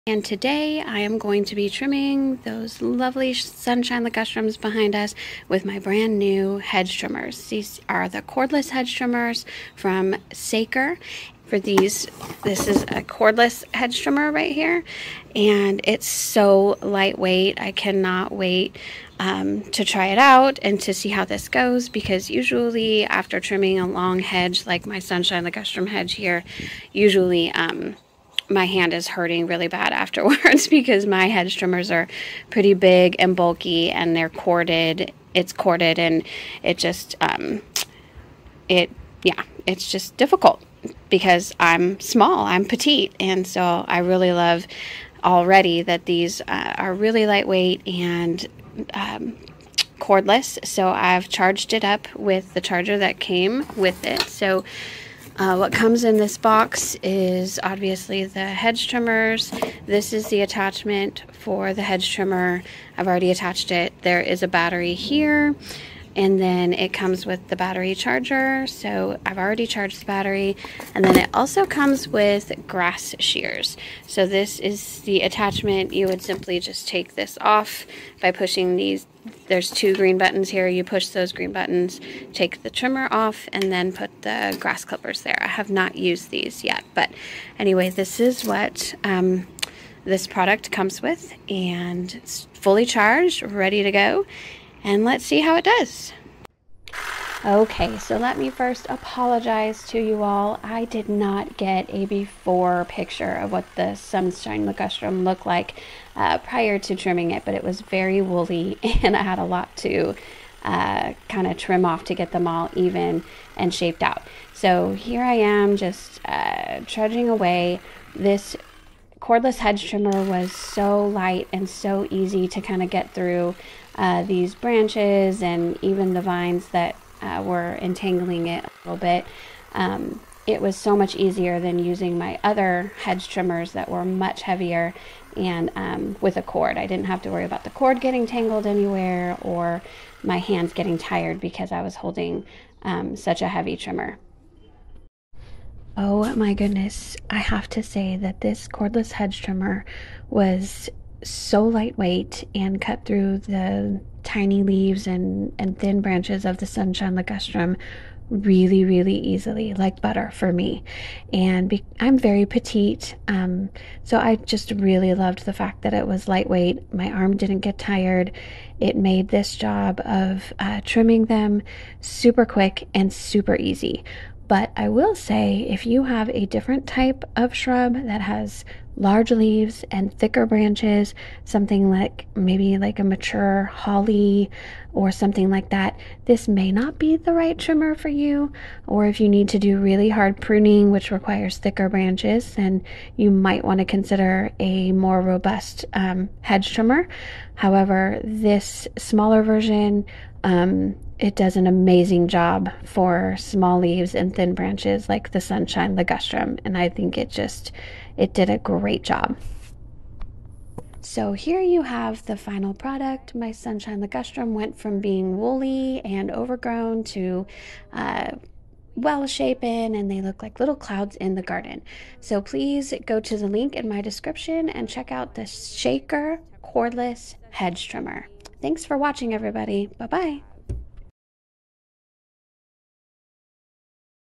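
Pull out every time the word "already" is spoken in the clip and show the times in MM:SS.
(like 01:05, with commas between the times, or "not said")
00:45, 01:03, 01:09.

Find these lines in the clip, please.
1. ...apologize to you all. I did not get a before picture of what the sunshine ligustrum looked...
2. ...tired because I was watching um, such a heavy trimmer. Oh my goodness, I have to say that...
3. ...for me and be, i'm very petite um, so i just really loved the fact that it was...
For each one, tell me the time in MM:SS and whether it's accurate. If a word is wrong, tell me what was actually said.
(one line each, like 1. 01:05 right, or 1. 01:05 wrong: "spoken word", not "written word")
1. 01:38 right
2. 02:20 wrong: "holding", not "watching"
3. 02:40 right.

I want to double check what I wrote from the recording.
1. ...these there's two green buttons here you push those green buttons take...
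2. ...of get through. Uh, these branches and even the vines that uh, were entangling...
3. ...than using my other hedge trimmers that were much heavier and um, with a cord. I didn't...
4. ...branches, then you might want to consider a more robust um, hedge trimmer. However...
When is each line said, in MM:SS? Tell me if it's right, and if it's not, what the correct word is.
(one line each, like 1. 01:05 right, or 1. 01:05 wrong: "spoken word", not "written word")
1. 01:18 right
2. 02:02 right
3. 02:11 right
4. 03:11 right.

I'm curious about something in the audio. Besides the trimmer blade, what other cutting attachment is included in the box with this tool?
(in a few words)
grass shears.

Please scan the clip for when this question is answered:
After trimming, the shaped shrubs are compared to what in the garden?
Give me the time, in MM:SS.
03:40.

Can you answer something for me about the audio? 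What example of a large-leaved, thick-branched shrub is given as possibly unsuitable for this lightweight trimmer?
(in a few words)
mature holly.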